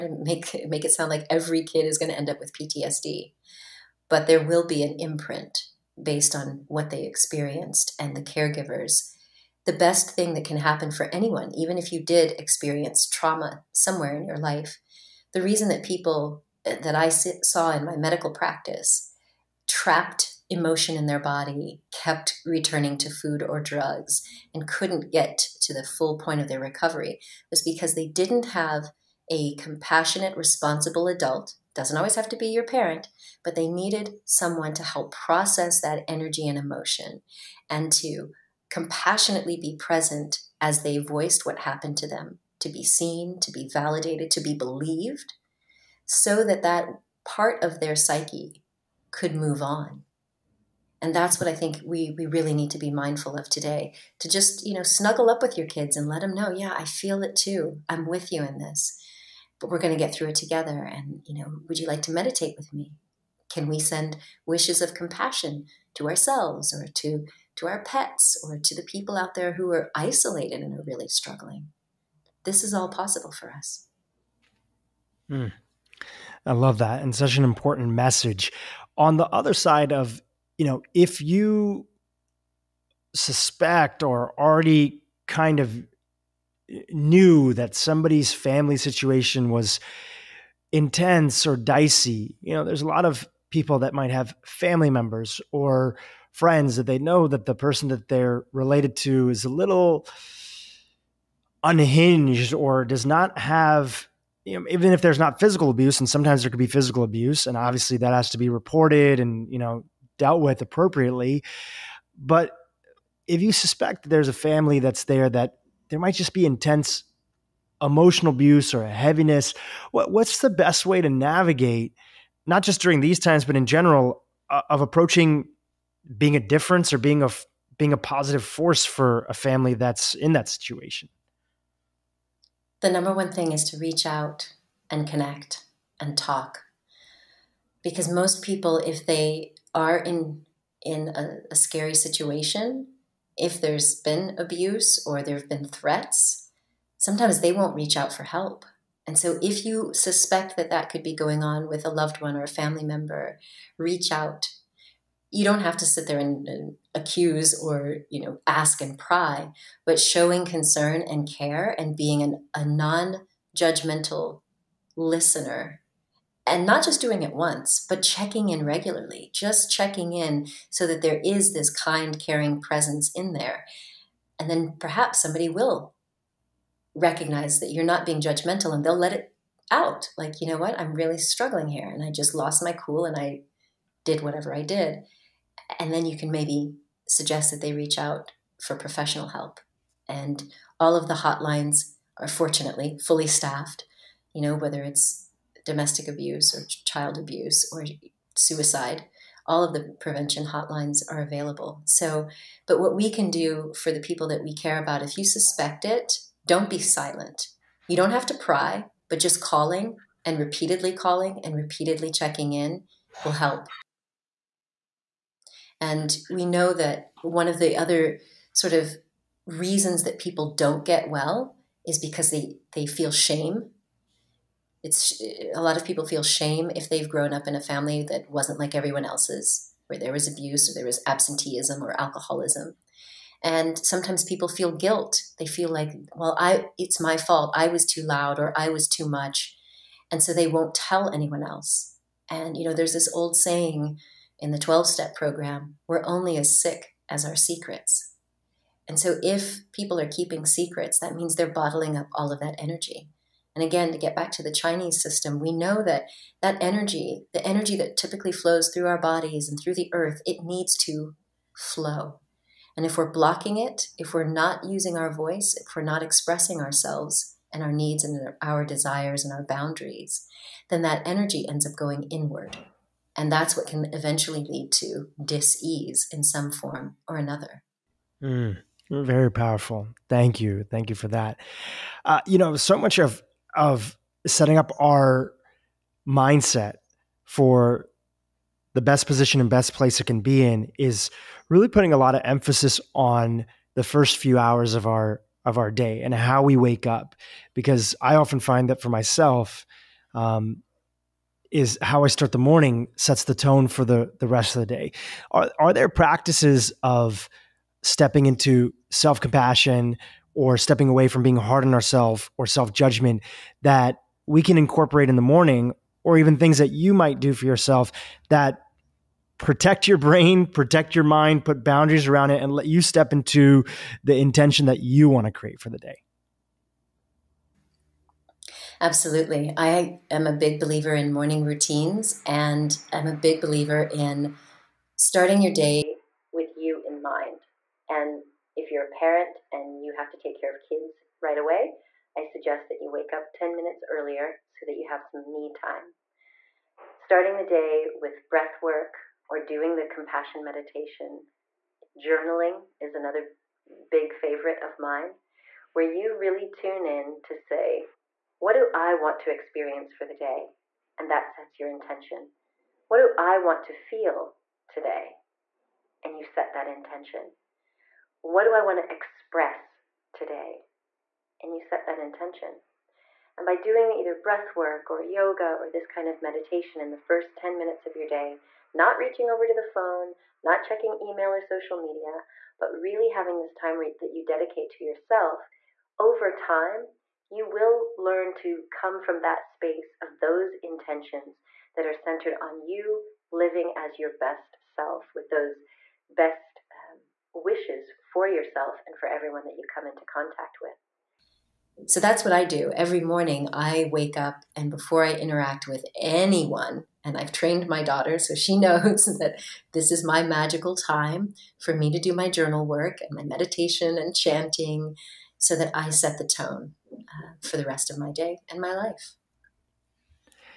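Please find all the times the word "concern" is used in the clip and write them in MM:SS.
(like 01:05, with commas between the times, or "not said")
02:40.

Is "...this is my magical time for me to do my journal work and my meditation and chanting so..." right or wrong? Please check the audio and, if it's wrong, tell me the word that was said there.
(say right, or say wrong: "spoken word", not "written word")
right.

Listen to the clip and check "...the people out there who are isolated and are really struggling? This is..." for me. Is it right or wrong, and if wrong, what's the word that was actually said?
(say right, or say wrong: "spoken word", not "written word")
right.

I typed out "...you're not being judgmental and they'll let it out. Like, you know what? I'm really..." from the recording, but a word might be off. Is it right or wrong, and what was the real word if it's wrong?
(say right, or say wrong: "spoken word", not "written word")
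right.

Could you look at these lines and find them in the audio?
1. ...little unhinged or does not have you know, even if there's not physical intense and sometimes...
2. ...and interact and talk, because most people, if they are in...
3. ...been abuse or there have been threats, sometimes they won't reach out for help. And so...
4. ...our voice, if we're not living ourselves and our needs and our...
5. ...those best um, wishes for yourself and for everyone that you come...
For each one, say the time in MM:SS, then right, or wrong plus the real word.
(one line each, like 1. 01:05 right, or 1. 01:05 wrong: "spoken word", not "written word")
1. 01:39 wrong: "abuse", not "intense"
2. 02:14 wrong: "connect", not "interact"
3. 02:23 right
4. 04:24 wrong: "expressing", not "living"
5. 06:35 right.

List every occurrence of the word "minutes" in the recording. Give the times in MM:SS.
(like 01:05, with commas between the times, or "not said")
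05:43, 06:17.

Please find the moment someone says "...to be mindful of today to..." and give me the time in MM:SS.
00:52.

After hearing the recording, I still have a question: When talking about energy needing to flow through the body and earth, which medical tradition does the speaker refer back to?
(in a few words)
Chinese system.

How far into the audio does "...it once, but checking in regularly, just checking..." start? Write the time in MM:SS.
02:47.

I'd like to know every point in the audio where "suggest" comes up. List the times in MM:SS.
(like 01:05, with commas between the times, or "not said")
03:07, 05:42.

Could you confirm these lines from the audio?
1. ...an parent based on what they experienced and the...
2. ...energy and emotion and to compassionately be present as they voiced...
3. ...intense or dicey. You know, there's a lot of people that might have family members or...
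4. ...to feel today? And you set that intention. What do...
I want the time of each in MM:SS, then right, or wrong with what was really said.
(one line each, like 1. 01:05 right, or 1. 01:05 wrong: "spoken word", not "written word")
1. 00:04 wrong: "imprint", not "parent"
2. 00:36 right
3. 01:30 right
4. 06:03 right.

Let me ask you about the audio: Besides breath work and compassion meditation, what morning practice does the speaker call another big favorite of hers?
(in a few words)
journaling.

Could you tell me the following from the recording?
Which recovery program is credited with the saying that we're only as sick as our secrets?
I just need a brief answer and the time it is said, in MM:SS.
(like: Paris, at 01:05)
12 step program, at 04:04.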